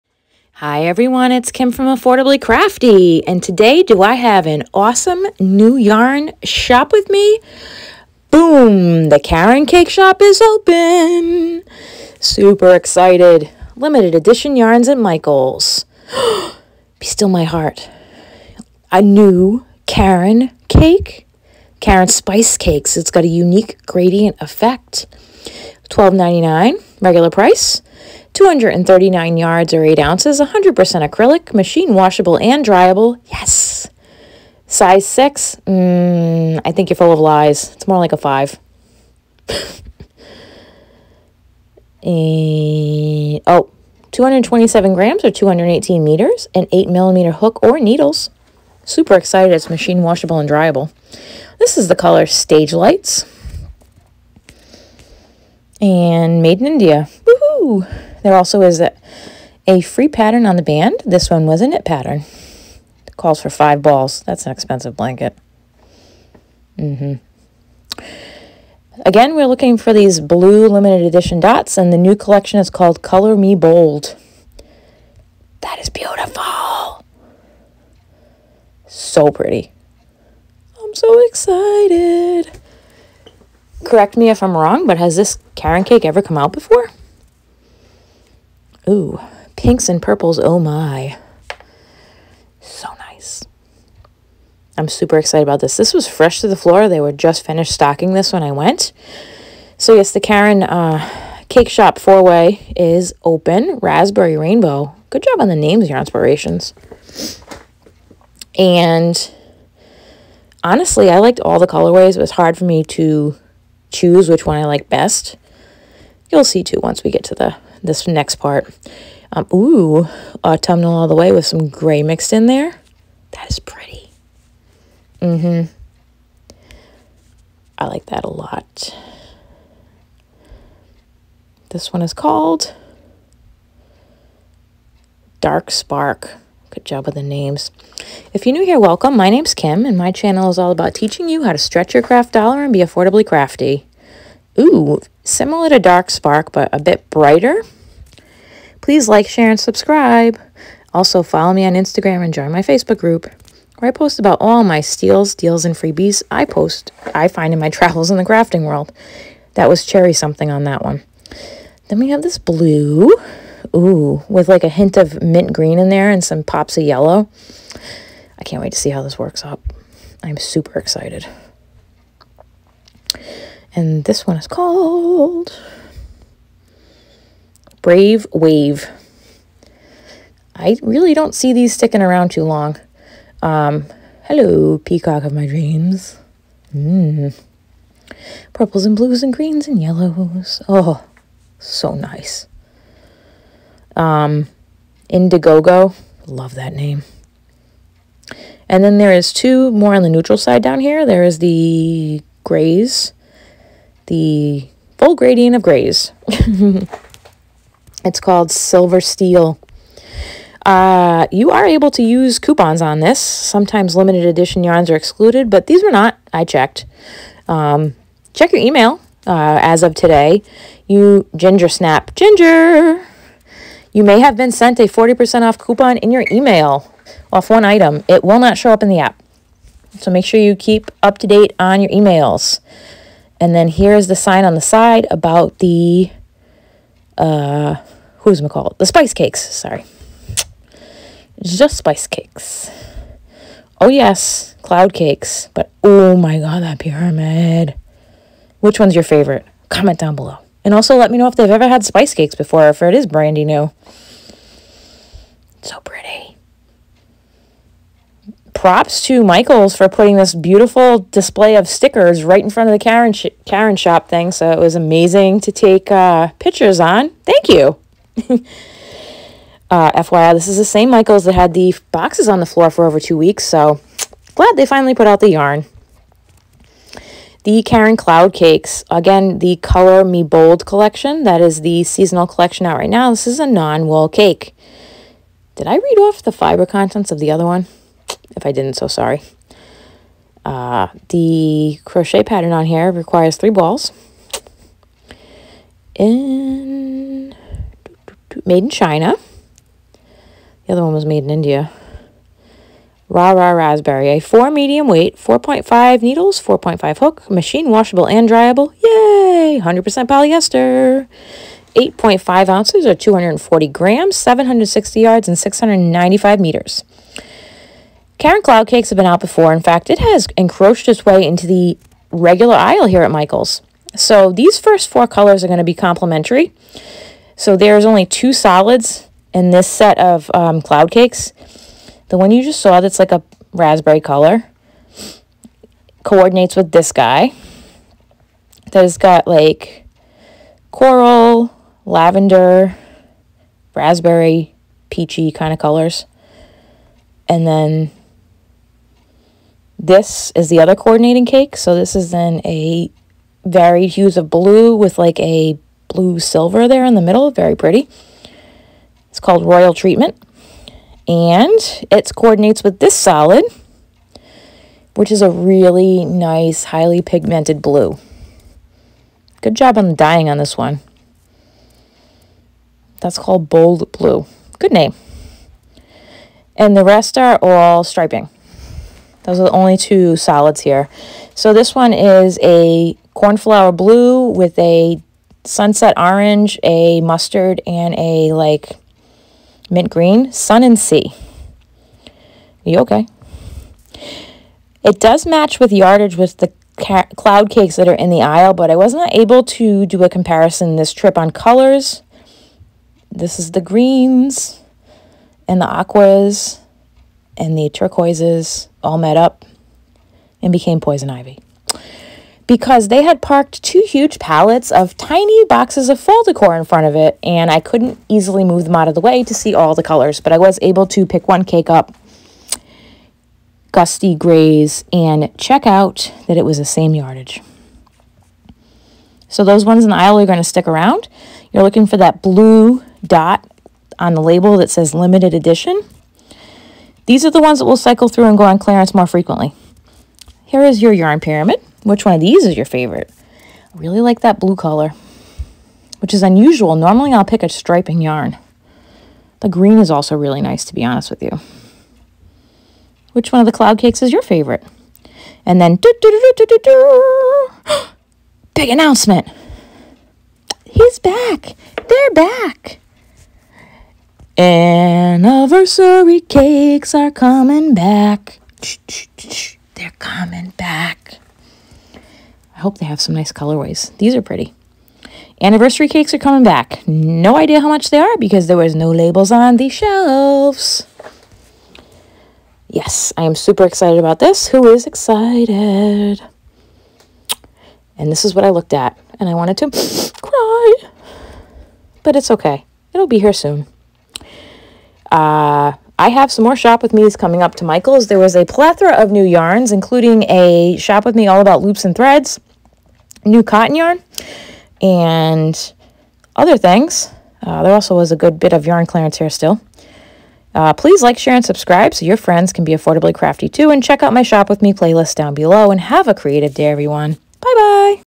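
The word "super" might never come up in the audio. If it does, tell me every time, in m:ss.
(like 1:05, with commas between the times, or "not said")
0:12, 0:48, 1:34, 2:50, 8:03.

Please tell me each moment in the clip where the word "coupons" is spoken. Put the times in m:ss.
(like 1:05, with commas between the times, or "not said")
3:32, 3:45.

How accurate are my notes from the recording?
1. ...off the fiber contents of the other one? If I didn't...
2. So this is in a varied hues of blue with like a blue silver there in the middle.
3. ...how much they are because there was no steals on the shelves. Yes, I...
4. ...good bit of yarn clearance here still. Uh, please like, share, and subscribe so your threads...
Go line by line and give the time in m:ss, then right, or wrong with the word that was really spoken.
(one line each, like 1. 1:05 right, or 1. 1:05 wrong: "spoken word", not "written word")
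1. 4:45 right
2. 5:51 right
3. 7:57 wrong: "labels", not "steals"
4. 8:28 wrong: "friends", not "threads".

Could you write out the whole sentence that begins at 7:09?
So those ones in the aisle are going to stick around.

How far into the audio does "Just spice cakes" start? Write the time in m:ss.
4:01.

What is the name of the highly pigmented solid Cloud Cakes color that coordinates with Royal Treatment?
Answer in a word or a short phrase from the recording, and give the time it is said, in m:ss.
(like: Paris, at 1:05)
Bold Blue, at 6:13.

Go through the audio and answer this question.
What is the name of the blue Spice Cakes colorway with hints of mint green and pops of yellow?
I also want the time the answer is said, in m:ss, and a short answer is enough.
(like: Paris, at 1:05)
Brave Wave, at 2:57.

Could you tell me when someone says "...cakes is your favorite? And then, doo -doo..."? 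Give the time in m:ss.
7:33.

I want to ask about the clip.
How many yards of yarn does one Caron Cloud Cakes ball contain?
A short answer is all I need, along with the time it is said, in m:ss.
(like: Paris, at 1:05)
760 yards, at 5:14.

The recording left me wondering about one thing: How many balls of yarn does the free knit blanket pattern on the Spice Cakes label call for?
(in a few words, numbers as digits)
5.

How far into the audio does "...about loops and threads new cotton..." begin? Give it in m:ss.
8:21.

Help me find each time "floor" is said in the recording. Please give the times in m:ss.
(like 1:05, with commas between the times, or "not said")
1:36, 4:32.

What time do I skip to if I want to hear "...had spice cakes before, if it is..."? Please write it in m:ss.
4:11.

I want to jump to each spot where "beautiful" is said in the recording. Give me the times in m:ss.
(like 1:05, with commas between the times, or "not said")
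1:15, 4:20.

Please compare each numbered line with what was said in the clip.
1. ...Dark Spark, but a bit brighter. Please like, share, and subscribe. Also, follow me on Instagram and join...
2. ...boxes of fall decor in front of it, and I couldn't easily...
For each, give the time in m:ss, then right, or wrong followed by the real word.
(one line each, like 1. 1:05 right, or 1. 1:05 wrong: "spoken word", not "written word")
1. 2:25 right
2. 6:55 right.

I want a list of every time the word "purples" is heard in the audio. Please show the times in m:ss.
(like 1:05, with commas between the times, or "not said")
1:30, 3:08.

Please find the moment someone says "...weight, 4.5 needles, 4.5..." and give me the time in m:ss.
5:04.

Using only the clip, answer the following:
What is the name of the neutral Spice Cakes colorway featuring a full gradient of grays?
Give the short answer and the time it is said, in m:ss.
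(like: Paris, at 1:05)
Silver Steel, at 3:28.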